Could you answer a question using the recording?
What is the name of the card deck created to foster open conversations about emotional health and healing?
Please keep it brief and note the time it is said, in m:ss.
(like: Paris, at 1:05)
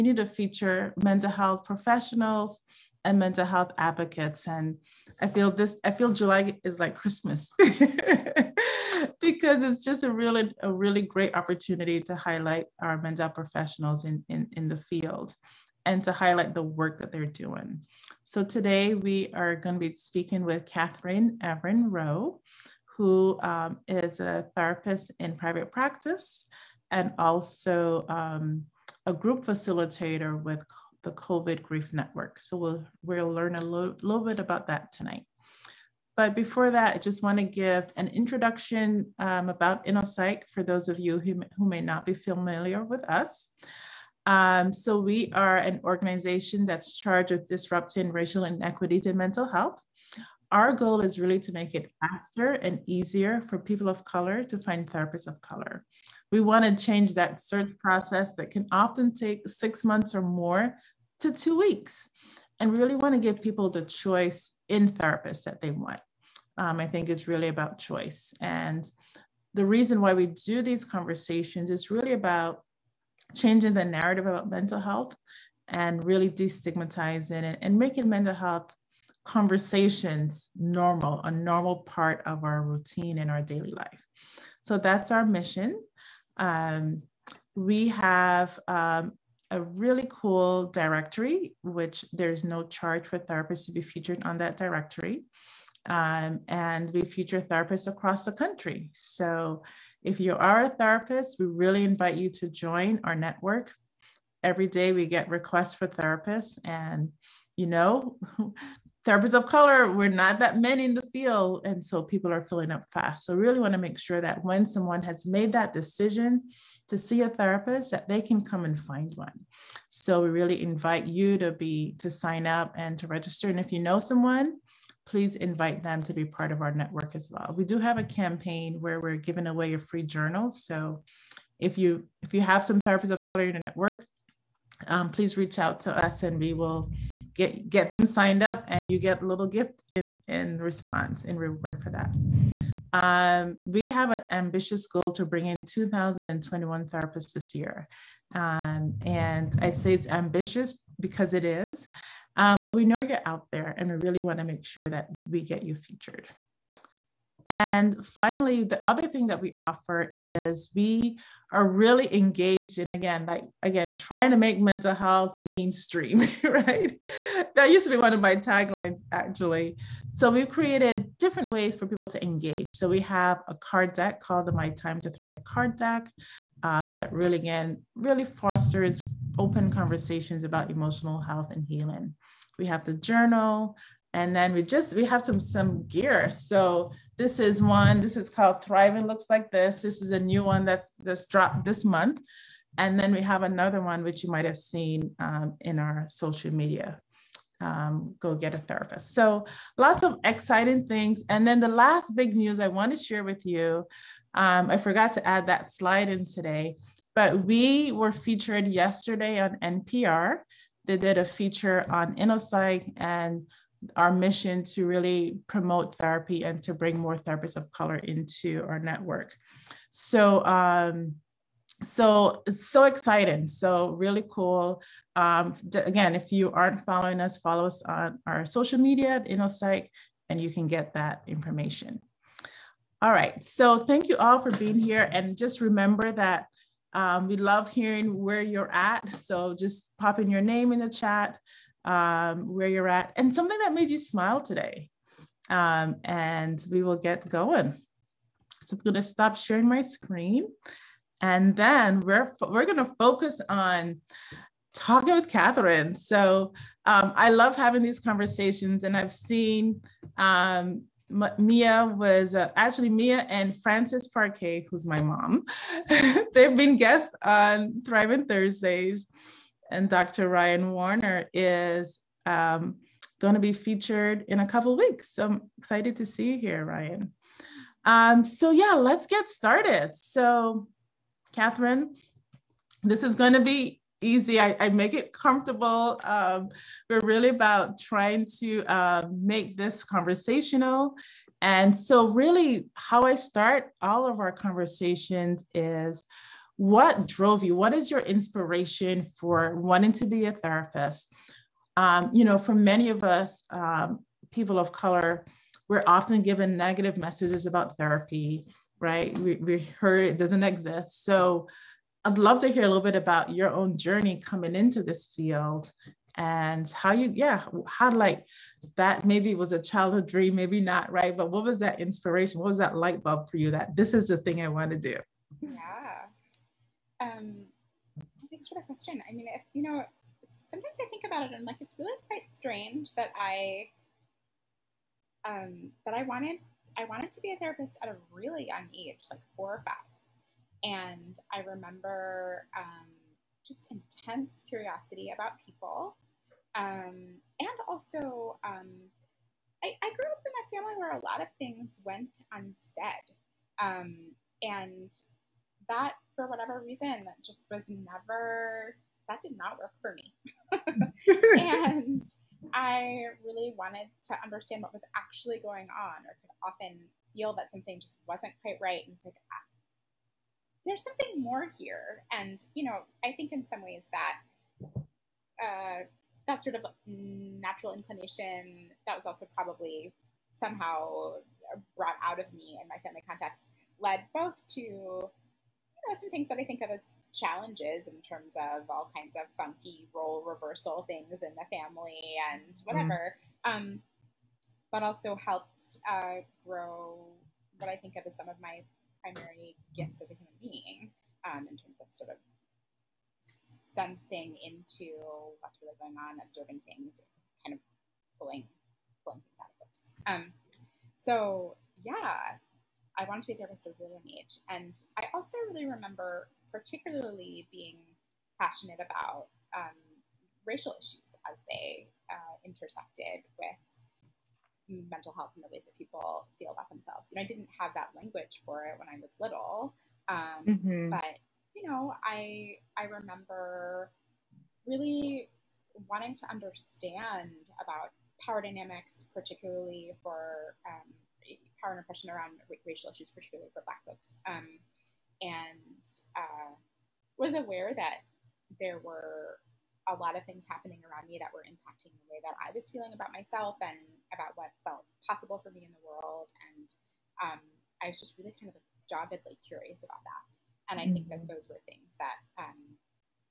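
My Time to Thrive, at 2:54.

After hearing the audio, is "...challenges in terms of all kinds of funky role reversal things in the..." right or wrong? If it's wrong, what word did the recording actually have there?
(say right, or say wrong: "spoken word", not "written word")
right.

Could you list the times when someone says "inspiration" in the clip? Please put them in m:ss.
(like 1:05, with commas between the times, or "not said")
4:58, 5:21.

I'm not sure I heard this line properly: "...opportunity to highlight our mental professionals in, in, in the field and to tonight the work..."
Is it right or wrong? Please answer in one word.
wrong.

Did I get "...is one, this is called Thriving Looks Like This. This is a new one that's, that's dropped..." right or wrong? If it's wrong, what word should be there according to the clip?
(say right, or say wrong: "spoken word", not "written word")
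right.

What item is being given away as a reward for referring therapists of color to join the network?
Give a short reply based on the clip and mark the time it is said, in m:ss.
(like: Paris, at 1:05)
a free journal, at 2:09.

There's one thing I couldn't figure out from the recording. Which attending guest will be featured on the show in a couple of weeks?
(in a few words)
Dr. Ryan Warner.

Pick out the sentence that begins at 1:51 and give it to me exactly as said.
And so people are filling up fast.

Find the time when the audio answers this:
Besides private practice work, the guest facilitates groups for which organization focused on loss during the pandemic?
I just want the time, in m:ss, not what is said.
0:31.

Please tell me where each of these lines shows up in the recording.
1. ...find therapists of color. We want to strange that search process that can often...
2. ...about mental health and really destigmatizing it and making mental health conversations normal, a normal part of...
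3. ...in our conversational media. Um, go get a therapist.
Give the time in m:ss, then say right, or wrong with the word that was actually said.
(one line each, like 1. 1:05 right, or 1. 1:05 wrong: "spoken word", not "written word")
1. 0:54 wrong: "change", not "strange"
2. 1:14 right
3. 3:15 wrong: "social", not "conversational".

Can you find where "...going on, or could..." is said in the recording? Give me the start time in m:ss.
6:05.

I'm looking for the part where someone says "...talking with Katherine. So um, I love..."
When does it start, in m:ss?
4:14.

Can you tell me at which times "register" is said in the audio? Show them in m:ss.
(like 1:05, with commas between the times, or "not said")
2:03.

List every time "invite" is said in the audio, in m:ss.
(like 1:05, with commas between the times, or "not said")
1:41, 2:00, 2:05.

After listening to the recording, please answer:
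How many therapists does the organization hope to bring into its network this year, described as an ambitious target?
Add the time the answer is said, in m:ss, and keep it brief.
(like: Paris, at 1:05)
2021, at 2:25.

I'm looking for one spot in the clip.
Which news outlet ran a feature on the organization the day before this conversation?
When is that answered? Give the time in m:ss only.
3:29.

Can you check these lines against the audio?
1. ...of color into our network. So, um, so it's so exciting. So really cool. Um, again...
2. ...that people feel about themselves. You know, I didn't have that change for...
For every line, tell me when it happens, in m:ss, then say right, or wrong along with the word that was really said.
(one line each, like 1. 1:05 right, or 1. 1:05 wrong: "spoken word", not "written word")
1. 3:37 right
2. 7:05 wrong: "language", not "change".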